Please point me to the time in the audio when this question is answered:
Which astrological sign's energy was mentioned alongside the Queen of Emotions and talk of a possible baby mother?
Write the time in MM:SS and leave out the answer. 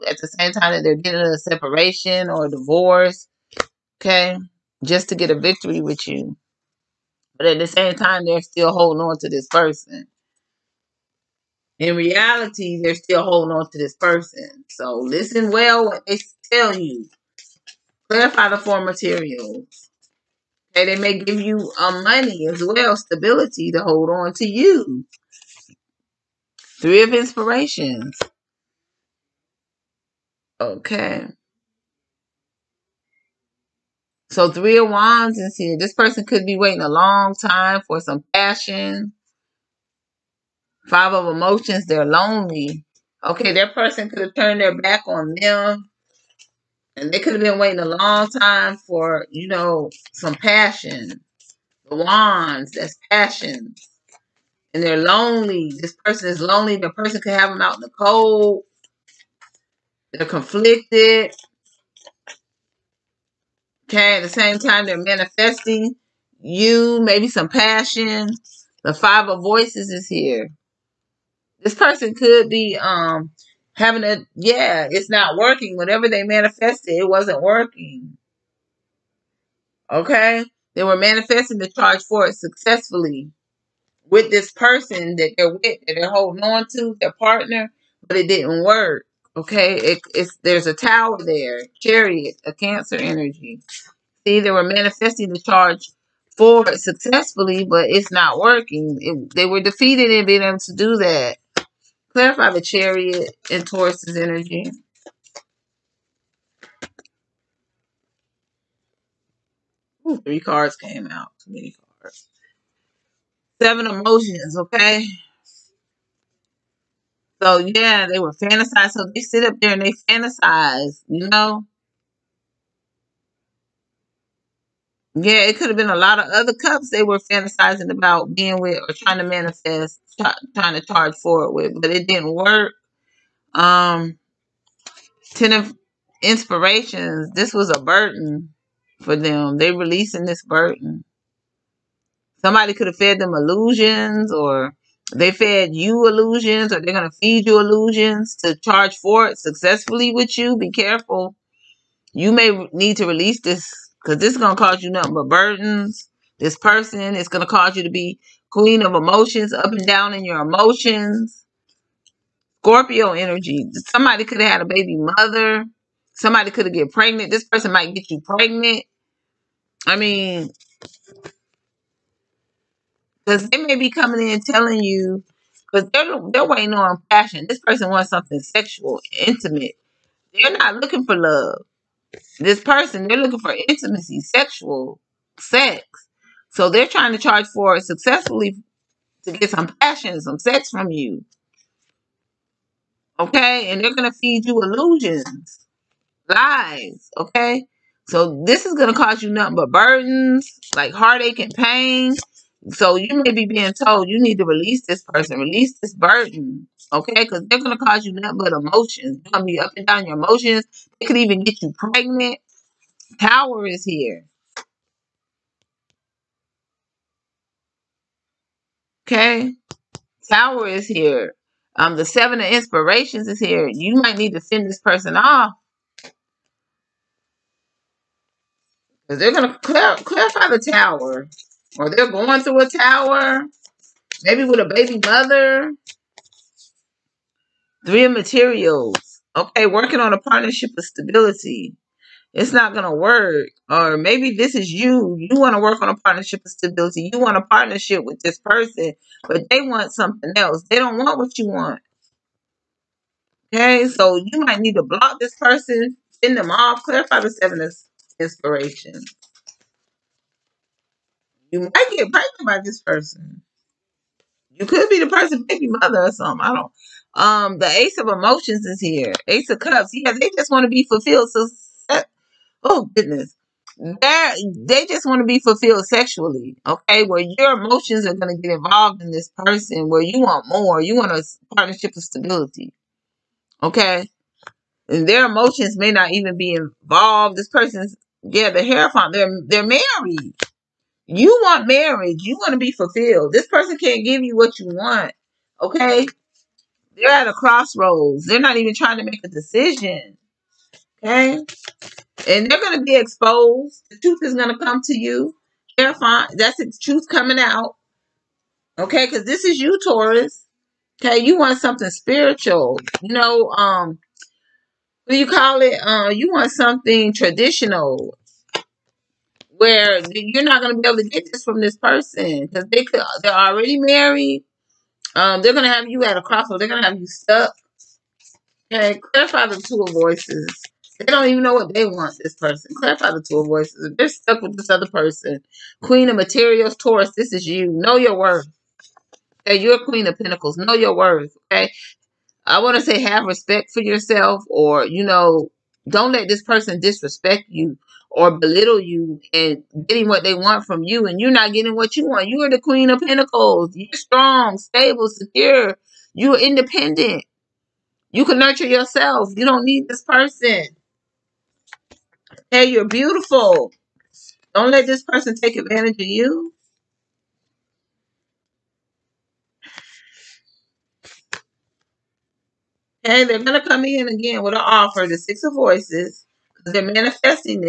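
02:42.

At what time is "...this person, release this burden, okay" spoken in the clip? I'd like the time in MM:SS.
03:24.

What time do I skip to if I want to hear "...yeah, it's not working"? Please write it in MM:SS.
01:14.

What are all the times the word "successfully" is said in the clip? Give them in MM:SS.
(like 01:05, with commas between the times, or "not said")
01:22, 01:36, 02:29, 03:07.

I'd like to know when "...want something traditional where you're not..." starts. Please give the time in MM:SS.
05:16.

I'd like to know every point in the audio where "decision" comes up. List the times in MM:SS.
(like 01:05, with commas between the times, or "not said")
04:59.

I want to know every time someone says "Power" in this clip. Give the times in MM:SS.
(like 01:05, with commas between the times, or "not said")
03:33, 03:40.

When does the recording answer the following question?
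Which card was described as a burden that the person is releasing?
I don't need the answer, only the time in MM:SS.
02:15.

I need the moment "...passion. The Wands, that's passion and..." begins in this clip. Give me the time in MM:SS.
00:50.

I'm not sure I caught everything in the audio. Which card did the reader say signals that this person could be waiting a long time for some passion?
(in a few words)
Three of Wands.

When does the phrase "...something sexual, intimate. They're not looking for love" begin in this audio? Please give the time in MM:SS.
02:58.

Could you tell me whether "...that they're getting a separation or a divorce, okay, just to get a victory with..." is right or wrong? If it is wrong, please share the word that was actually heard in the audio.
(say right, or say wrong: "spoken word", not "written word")
right.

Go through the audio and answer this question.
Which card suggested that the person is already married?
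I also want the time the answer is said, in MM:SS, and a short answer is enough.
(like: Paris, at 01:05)
The Hierophant, at 04:48.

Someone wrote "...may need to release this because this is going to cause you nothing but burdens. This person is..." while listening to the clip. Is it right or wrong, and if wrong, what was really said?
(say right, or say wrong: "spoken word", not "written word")
right.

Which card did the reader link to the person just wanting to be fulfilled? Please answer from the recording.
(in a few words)
Ace of Cups.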